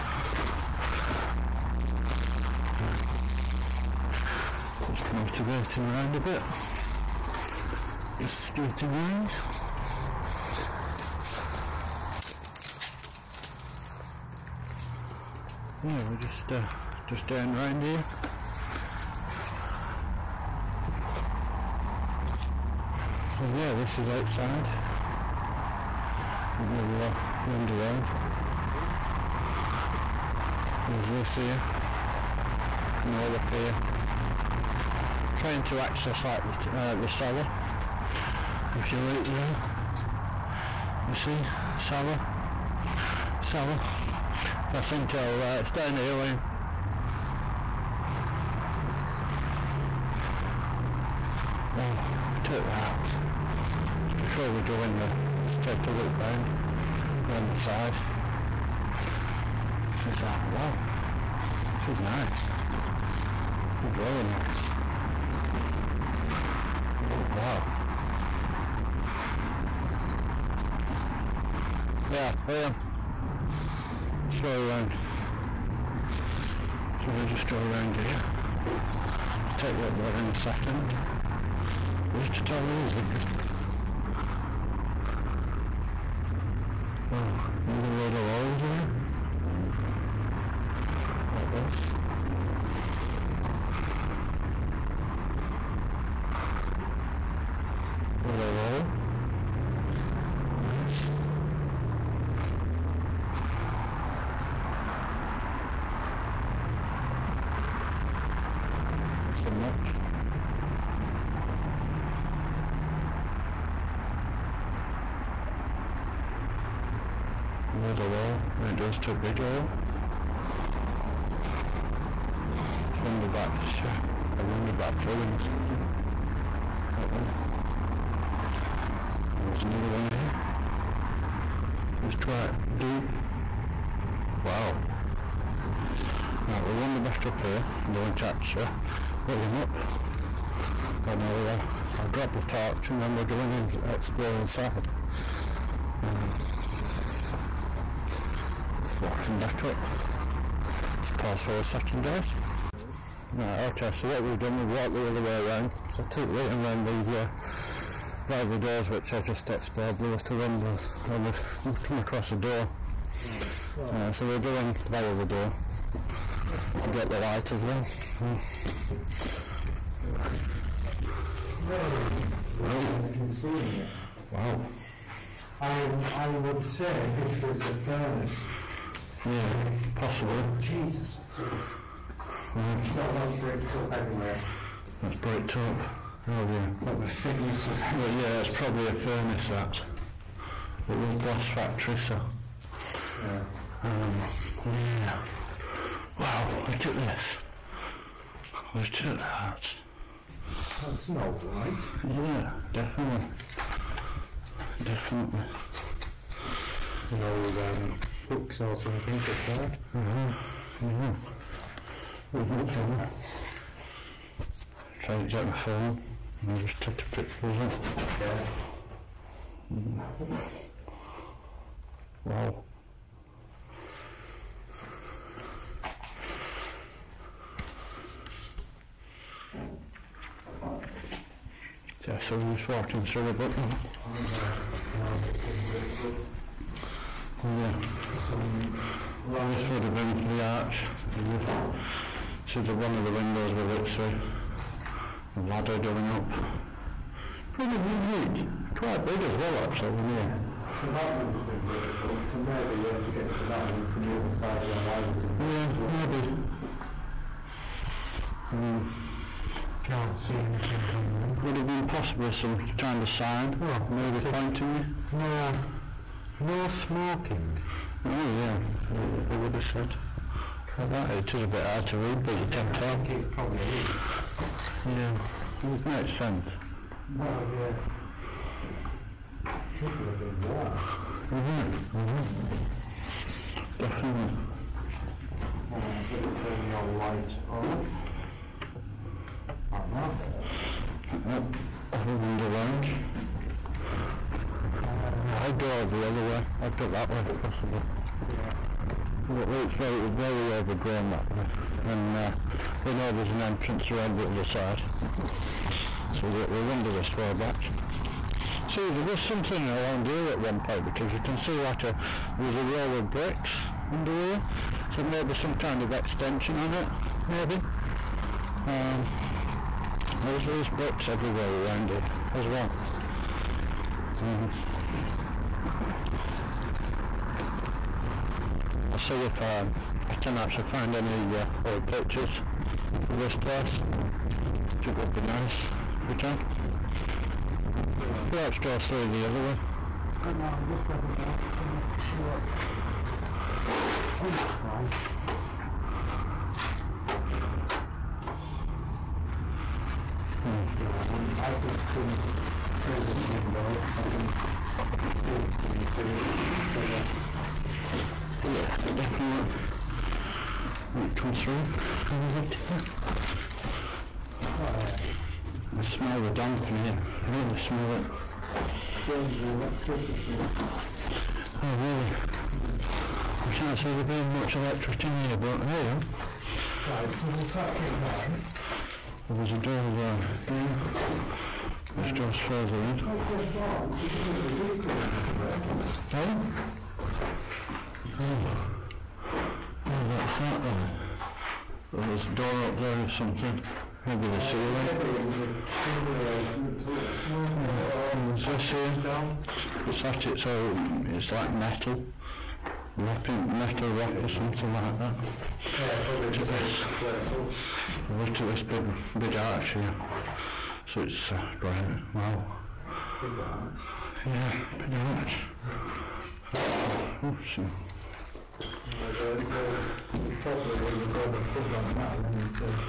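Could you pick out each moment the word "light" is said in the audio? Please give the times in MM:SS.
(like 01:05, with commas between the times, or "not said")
02:47, 03:21, 04:46.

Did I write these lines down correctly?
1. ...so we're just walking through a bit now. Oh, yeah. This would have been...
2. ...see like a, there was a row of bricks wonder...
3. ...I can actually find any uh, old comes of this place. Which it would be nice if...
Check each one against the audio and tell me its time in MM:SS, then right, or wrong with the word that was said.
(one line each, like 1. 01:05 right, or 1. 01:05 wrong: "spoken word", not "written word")
1. 03:52 right
2. 05:11 wrong: "under", not "wonder"
3. 05:30 wrong: "pictures", not "comes".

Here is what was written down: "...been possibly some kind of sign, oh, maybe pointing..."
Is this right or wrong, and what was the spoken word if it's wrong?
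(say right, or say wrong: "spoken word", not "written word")
right.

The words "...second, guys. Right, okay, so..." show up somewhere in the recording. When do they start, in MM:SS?
02:31.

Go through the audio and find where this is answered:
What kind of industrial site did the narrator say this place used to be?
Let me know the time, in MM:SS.
03:11.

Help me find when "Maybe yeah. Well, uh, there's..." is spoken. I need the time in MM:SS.
06:34.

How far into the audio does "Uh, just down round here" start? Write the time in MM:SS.
00:16.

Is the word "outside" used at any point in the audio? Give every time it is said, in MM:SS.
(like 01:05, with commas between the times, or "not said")
00:24.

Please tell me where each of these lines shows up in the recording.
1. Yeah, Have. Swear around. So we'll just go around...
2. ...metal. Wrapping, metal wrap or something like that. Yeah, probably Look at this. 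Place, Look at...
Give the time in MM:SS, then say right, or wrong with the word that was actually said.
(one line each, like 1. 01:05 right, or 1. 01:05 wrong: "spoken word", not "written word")
1. 01:12 wrong: "Liam", not "Have"
2. 06:41 right.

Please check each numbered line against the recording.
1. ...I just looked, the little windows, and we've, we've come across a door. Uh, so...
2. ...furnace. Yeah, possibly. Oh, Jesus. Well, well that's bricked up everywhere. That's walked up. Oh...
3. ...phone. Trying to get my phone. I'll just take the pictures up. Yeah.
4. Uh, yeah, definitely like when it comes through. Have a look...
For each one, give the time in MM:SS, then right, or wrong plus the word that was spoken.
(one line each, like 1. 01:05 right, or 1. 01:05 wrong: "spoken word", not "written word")
1. 02:39 wrong: "explored", not "looked"
2. 02:57 wrong: "bricked", not "walked"
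3. 03:32 right
4. 05:56 right.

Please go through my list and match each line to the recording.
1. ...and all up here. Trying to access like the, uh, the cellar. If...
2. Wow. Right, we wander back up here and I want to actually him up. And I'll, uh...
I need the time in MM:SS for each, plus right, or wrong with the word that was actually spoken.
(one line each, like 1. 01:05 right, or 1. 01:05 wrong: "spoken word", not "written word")
1. 00:33 right
2. 02:14 right.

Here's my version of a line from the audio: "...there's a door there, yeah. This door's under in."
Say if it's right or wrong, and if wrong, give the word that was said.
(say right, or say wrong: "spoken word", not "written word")
wrong: "further", not "under".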